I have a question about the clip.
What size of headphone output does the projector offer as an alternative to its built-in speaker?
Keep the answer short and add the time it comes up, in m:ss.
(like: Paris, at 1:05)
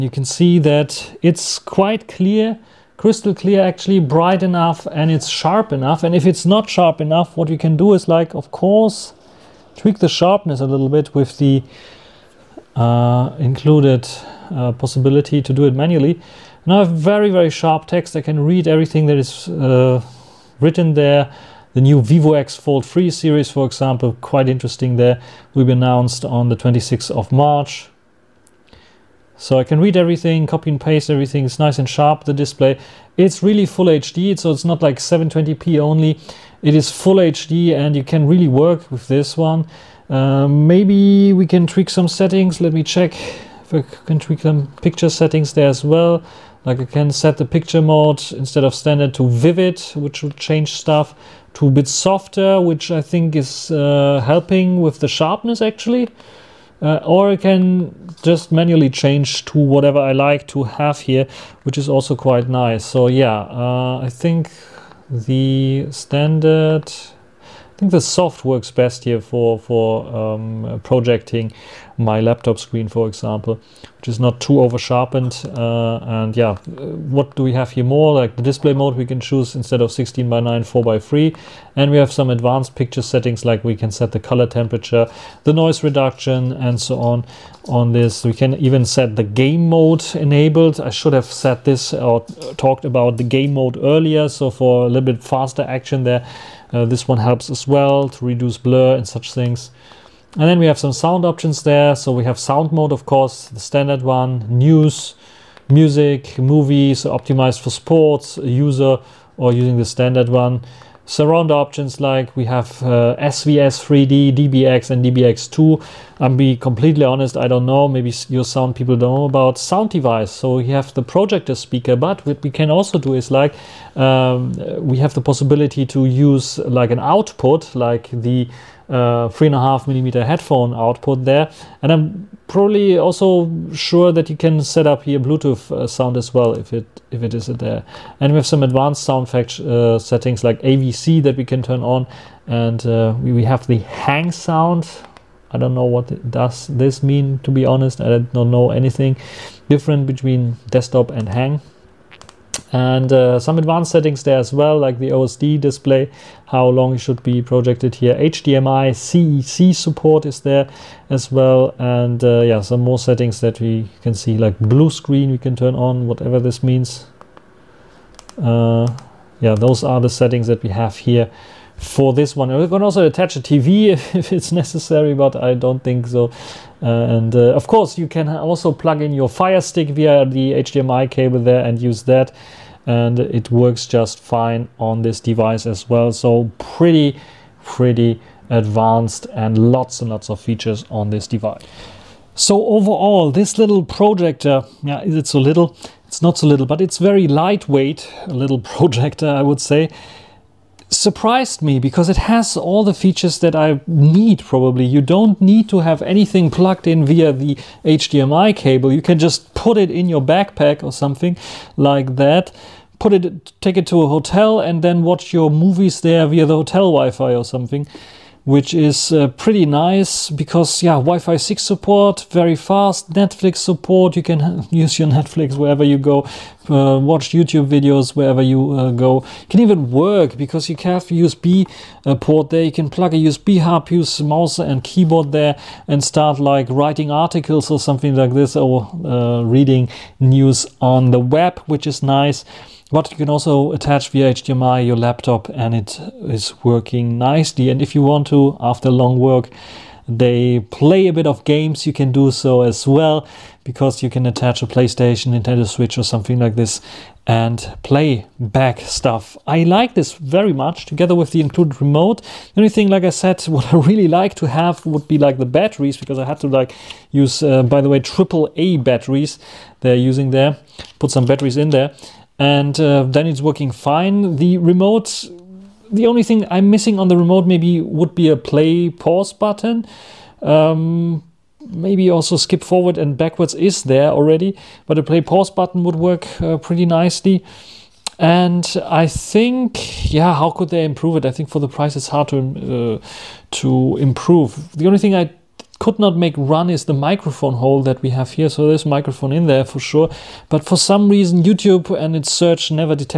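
3.5 millimeter, at 2:09.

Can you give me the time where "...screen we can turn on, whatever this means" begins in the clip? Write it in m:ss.
2:44.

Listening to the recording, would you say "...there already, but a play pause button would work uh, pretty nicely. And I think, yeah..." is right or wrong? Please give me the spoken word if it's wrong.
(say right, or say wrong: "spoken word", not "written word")
right.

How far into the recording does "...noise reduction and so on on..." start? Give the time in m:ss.
1:25.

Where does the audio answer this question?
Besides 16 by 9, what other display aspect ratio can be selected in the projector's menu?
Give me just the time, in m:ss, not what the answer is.
1:20.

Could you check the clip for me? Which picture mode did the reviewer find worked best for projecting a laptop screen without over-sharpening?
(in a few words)
Soft.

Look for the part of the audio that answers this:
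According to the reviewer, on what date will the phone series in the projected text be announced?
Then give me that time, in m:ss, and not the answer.
0:26.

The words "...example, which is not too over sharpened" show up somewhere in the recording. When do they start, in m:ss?
1:13.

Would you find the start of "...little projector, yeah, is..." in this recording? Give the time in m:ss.
3:13.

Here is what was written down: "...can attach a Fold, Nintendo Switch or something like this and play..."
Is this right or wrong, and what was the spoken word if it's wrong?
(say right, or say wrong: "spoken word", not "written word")
wrong: "PlayStation", not "Fold".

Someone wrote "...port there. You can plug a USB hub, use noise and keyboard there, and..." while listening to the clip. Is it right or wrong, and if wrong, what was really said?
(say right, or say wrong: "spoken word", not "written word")
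wrong: "mouse", not "noise".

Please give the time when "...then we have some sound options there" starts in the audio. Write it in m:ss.
1:40.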